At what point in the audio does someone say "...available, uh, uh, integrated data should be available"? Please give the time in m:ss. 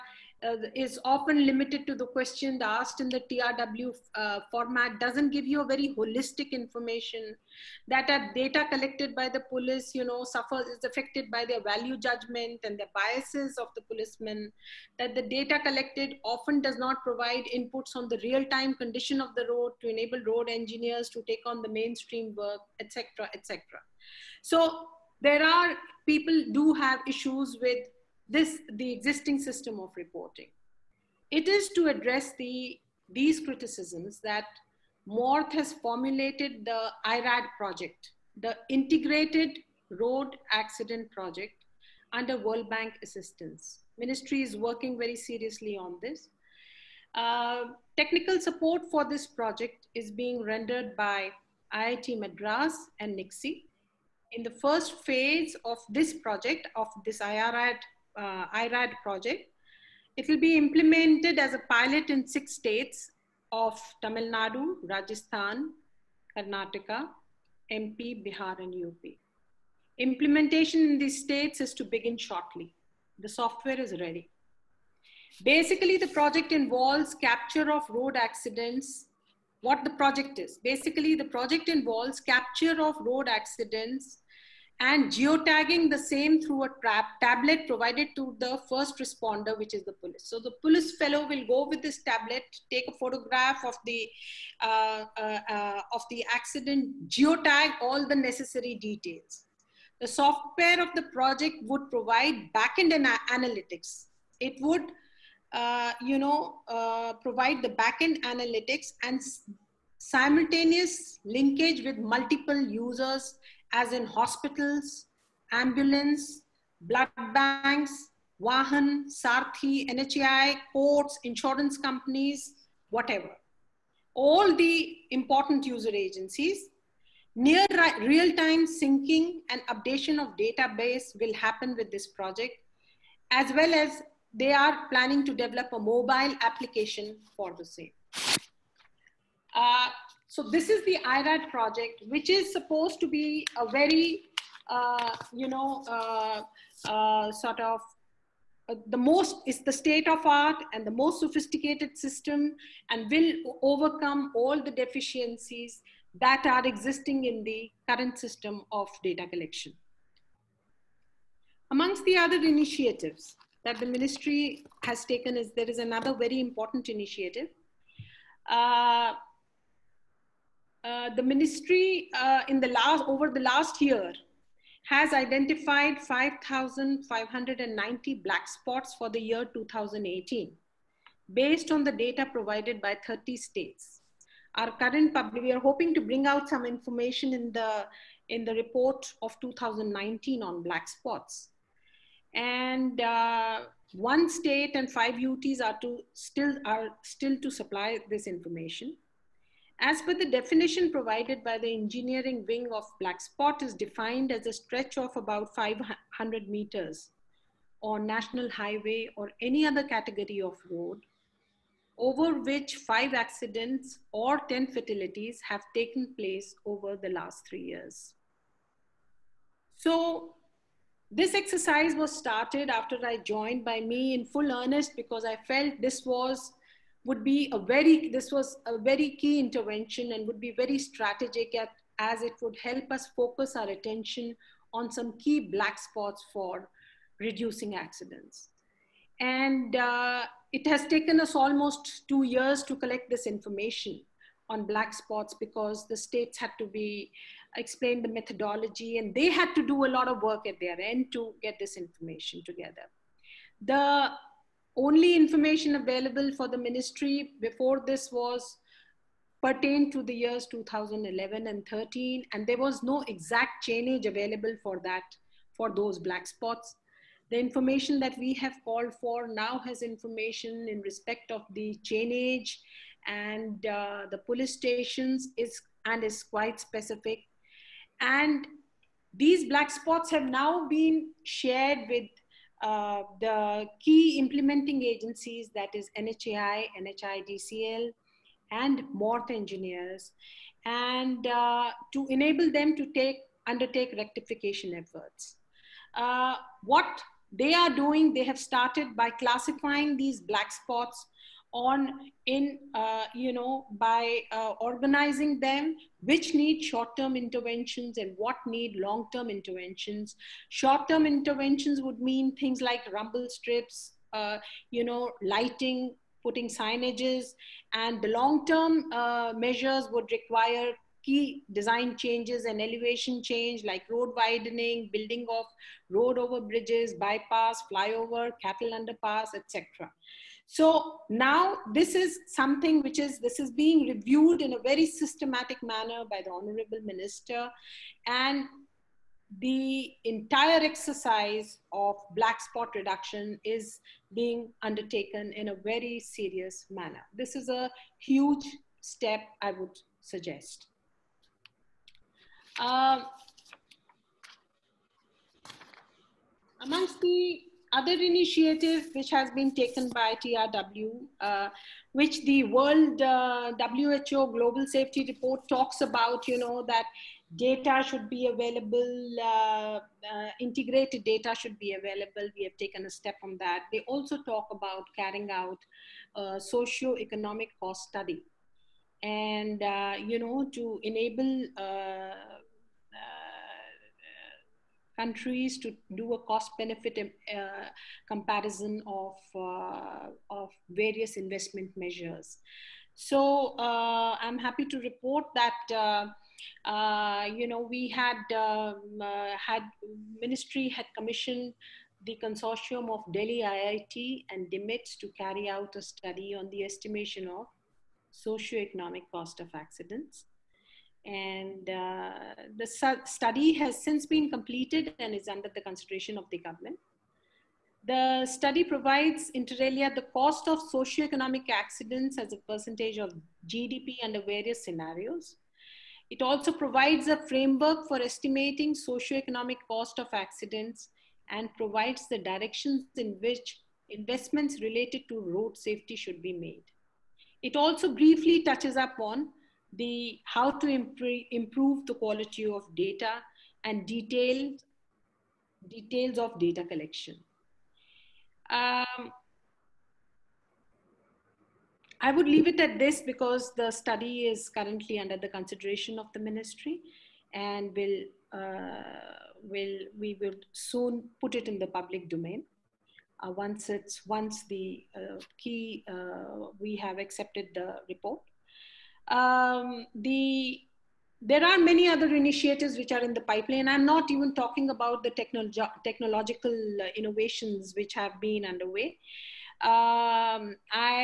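6:08.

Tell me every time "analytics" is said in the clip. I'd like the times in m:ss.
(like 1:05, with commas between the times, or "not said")
1:43, 1:48.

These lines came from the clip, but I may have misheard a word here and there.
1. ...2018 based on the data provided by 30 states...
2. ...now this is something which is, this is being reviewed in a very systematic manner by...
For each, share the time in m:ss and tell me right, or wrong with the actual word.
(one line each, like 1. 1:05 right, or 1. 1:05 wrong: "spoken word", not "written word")
1. 2:59 right
2. 5:31 right.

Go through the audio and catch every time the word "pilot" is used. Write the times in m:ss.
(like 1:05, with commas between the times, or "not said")
1:01.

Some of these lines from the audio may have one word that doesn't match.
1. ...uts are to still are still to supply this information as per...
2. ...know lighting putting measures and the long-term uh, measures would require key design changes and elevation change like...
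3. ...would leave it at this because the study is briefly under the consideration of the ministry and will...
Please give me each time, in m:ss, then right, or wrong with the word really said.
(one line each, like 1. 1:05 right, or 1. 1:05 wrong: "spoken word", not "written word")
1. 3:15 right
2. 5:14 wrong: "signages", not "measures"
3. 7:32 wrong: "currently", not "briefly".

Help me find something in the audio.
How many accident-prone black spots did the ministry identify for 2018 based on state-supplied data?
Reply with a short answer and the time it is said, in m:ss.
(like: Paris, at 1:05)
5590, at 2:56.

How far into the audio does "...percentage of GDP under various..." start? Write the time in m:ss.
7:02.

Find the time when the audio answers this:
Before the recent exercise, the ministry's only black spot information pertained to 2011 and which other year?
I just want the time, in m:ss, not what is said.
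4:21.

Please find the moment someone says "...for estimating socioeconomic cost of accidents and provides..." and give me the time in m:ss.
7:07.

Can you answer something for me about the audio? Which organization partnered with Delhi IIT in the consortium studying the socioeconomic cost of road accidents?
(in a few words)
DIMTS.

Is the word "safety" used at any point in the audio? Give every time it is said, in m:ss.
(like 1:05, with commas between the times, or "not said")
6:04, 7:15.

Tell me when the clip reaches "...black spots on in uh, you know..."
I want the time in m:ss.
5:00.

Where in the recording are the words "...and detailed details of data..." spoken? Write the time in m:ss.
7:23.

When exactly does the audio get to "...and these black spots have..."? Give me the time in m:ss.
4:37.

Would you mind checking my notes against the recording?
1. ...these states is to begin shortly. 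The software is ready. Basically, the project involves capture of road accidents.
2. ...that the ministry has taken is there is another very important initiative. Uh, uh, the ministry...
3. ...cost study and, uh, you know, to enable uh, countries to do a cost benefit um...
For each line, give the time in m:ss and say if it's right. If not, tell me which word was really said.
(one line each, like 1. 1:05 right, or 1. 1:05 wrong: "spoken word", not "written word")
1. 1:10 right
2. 2:43 right
3. 6:17 right.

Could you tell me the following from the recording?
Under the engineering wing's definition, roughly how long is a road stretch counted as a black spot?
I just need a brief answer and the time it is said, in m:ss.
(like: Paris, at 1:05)
500 meters, at 3:25.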